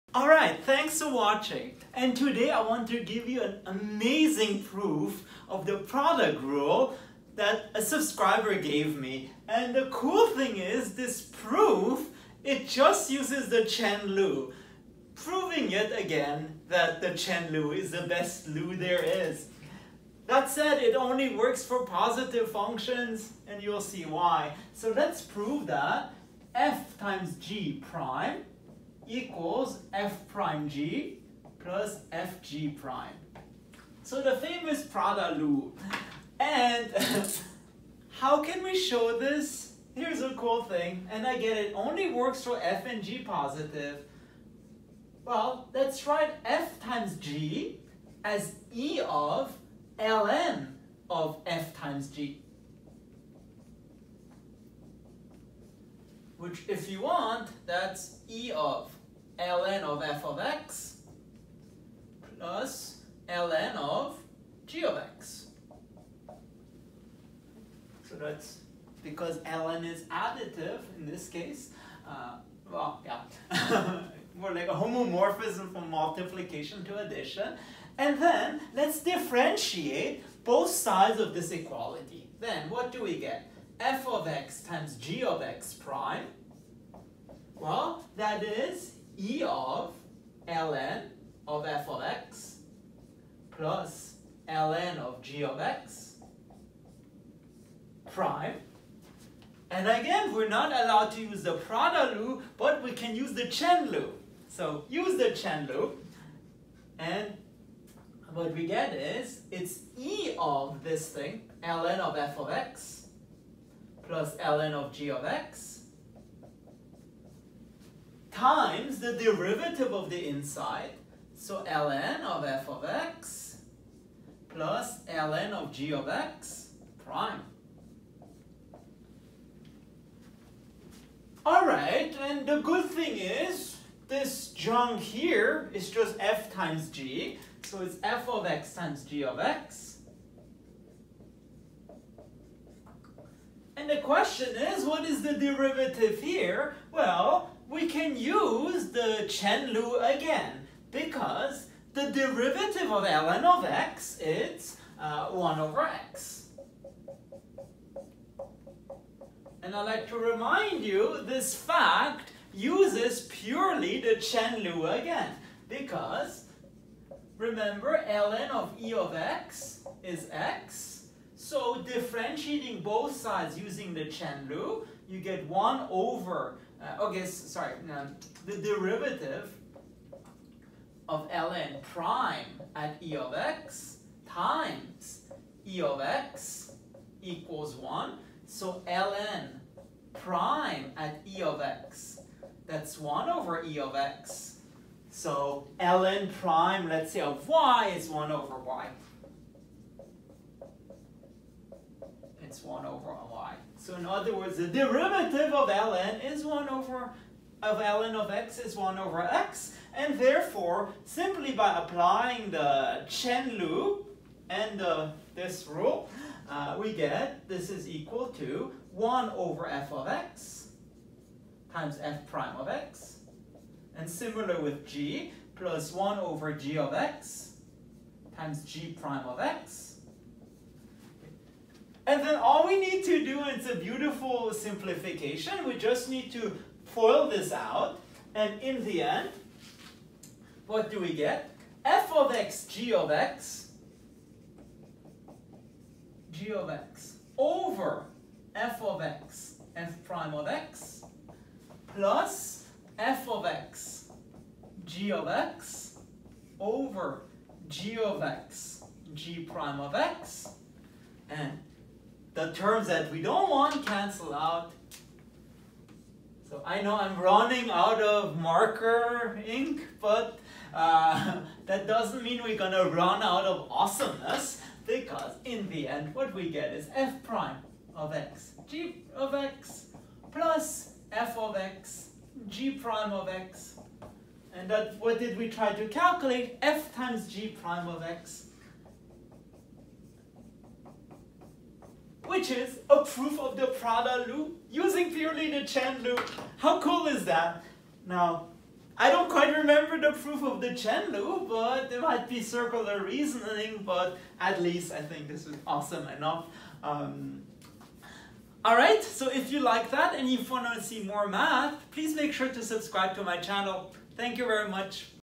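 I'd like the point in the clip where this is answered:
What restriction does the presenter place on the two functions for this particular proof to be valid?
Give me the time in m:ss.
0:21.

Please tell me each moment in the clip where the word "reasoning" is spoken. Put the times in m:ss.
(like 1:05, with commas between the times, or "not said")
5:03.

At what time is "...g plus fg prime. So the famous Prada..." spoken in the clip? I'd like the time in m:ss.
0:30.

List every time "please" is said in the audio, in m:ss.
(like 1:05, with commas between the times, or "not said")
5:11.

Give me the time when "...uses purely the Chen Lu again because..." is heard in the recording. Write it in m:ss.
2:42.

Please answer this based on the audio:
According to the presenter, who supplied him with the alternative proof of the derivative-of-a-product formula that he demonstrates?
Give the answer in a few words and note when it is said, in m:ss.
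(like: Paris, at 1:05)
A subscriber, at 0:07.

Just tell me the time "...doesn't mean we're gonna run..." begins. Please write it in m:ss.
4:31.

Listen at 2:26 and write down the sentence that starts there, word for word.
Well, can use the Chen Lu again because the derivative of ln of x is uh, 1 over x.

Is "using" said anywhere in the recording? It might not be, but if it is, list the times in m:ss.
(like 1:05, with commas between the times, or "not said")
2:53, 4:54.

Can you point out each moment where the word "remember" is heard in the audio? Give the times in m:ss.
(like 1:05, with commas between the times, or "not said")
2:47, 4:59.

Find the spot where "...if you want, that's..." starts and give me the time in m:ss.
0:56.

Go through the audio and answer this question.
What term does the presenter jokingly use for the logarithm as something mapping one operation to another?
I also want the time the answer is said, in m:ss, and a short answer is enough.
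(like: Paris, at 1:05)
A homomorphism, at 1:14.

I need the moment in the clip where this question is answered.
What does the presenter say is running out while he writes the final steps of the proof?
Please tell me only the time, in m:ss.
4:28.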